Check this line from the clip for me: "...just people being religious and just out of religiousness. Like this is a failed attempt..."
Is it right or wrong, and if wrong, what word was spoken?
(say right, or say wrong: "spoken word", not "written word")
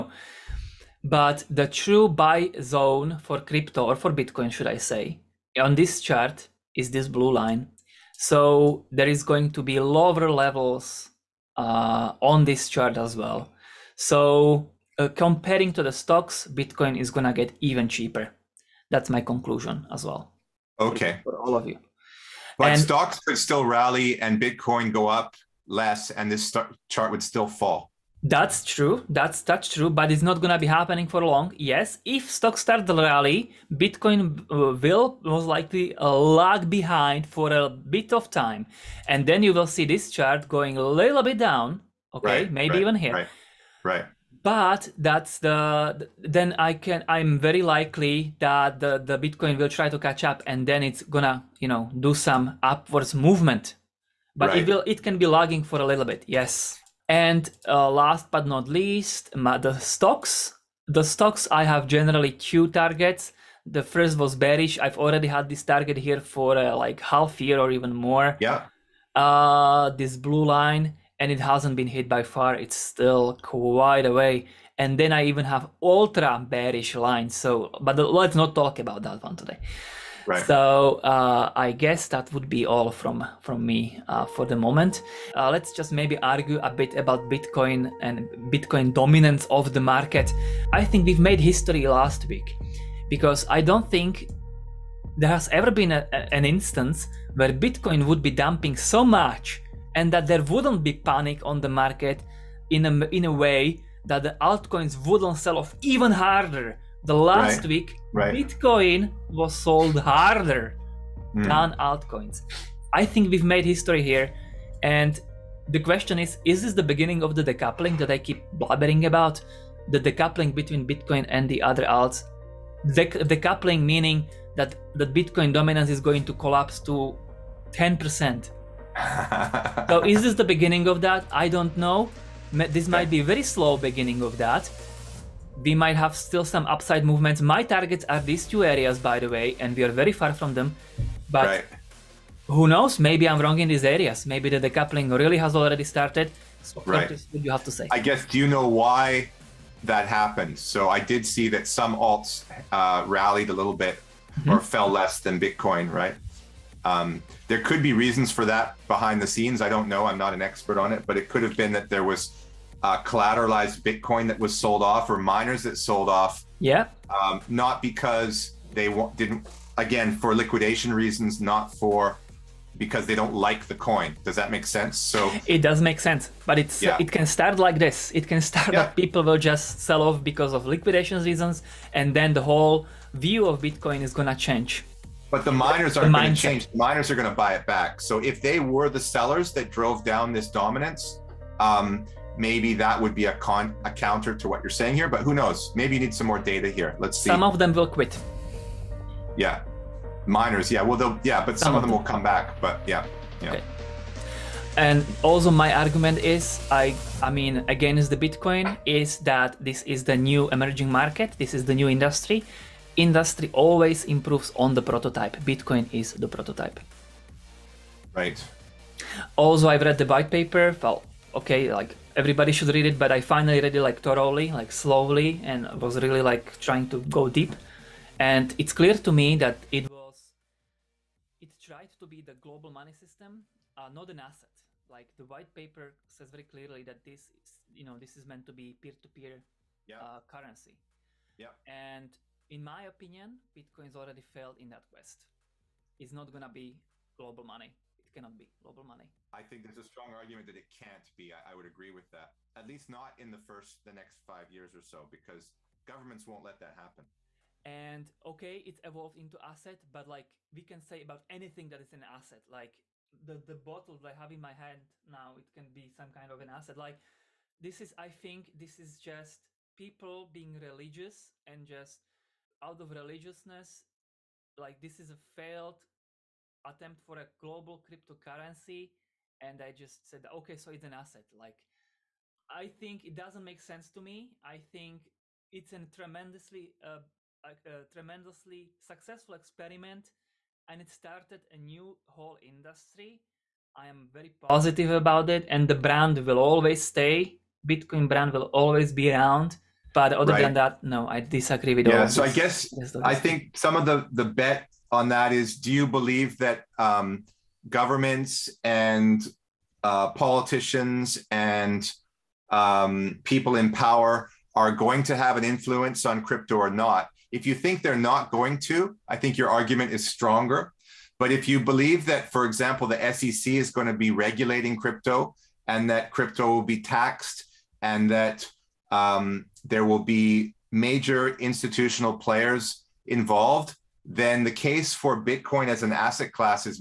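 right.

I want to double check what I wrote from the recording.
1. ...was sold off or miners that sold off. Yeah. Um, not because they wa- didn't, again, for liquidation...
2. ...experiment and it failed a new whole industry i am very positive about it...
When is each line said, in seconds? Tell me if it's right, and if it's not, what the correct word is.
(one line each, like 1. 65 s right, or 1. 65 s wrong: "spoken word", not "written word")
1. 164 s right
2. 289 s wrong: "started", not "failed".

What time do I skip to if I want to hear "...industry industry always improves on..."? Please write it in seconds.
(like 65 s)
211 s.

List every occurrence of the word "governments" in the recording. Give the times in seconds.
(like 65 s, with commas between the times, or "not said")
255 s, 307 s.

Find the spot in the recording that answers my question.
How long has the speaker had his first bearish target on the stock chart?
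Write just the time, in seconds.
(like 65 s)
66 s.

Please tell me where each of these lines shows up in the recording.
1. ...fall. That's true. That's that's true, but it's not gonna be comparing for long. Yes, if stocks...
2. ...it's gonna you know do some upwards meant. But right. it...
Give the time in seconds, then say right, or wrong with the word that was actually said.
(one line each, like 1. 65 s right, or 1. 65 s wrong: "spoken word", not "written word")
1. 27 s wrong: "happening", not "comparing"
2. 50 s wrong: "movement", not "meant".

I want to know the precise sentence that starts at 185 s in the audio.
But the miners aren't going to change.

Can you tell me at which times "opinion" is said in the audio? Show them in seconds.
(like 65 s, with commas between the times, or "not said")
242 s.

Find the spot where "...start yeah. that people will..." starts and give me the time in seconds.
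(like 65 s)
178 s.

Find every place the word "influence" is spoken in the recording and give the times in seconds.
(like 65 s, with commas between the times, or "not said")
315 s.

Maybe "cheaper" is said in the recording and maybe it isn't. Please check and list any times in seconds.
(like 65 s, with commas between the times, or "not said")
17 s.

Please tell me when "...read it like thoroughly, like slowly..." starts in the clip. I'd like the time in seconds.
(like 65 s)
223 s.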